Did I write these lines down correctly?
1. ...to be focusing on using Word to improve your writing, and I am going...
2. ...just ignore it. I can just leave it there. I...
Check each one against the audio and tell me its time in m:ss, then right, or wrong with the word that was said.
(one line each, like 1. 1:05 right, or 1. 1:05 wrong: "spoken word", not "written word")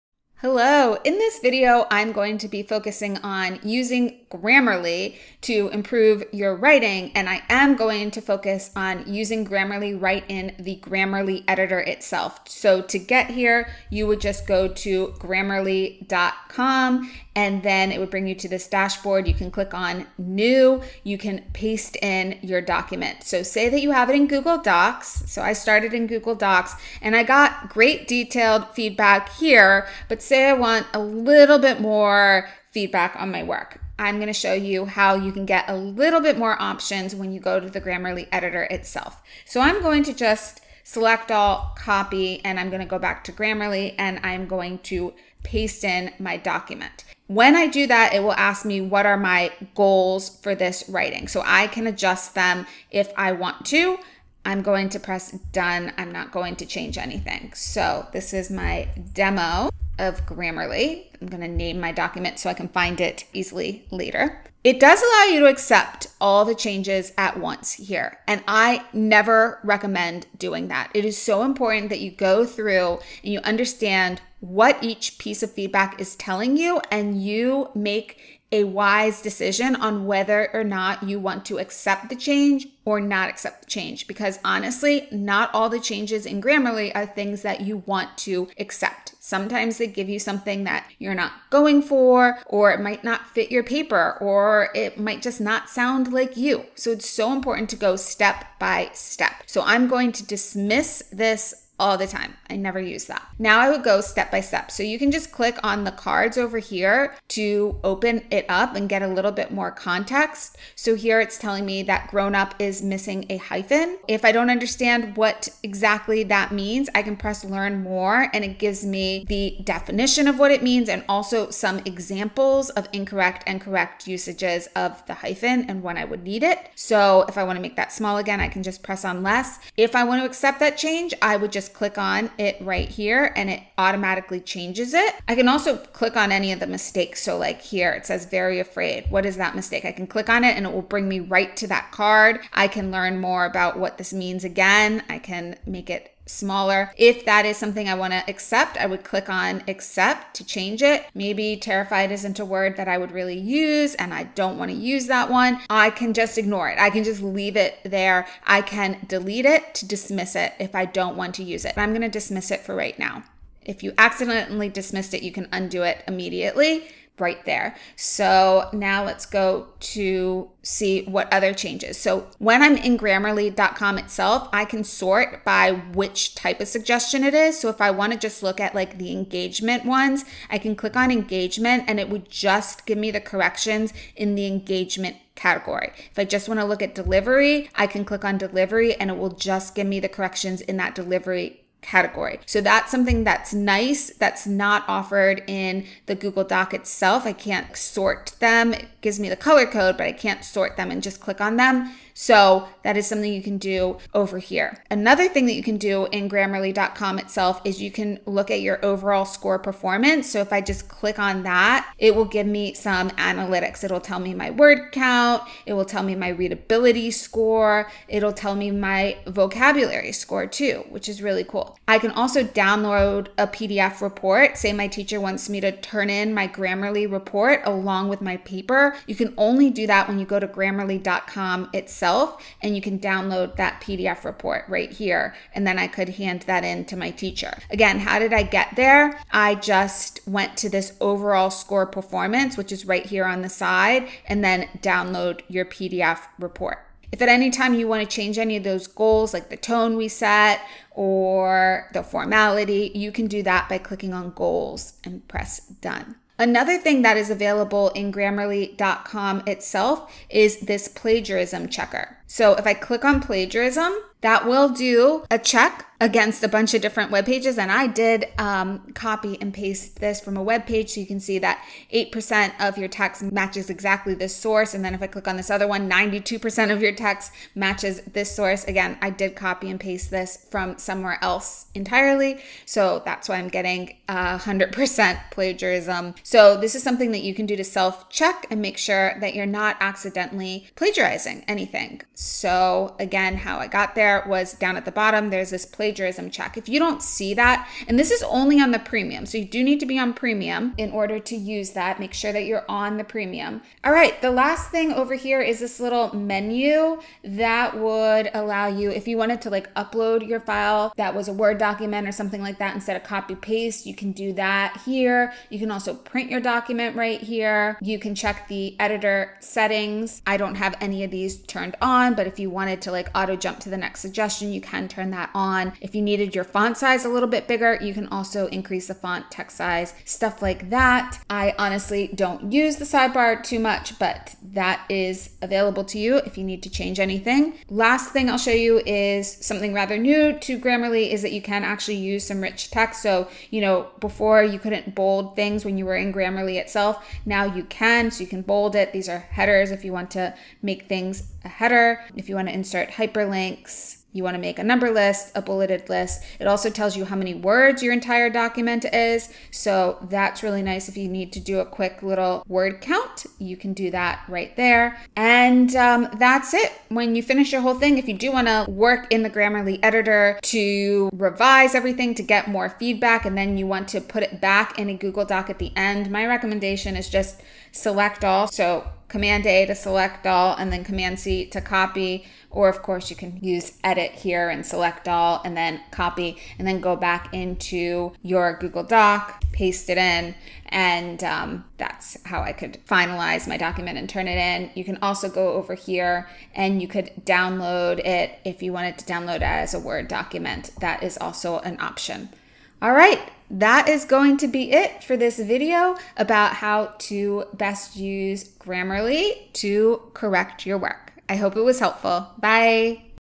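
1. 0:02 wrong: "Grammarly", not "Word"
2. 2:36 right.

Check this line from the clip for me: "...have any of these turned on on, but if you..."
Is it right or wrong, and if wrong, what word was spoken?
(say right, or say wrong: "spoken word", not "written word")
right.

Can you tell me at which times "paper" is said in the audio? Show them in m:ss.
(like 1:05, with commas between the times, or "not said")
1:33, 3:48.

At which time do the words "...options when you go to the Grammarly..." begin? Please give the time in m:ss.
0:36.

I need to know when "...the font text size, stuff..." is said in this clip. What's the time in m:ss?
5:28.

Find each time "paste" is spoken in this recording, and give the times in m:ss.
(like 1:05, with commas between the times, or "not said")
0:21, 0:45, 4:29, 4:39, 5:13, 6:29.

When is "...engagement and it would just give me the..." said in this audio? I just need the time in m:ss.
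3:01.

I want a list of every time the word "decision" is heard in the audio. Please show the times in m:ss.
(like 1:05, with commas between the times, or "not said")
1:19.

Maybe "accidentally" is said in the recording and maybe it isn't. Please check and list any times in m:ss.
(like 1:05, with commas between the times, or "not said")
2:43, 4:49.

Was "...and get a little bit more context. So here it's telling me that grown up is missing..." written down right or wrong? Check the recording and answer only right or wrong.
right.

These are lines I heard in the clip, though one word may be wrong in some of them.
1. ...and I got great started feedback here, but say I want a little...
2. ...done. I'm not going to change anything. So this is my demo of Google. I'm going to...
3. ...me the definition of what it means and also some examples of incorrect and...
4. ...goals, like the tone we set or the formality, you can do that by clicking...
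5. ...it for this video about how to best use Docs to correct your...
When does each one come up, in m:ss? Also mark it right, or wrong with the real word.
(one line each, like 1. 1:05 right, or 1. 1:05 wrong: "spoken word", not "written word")
1. 0:27 wrong: "detailed", not "started"
2. 0:55 wrong: "Grammarly", not "Google"
3. 1:58 right
4. 4:08 right
5. 6:44 wrong: "Grammarly", not "Docs".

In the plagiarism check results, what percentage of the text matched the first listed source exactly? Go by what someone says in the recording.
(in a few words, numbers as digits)
8%.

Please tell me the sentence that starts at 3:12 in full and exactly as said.
So that's something that's nice that's not offered in the Google Doc itself.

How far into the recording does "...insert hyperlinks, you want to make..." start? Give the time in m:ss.
5:52.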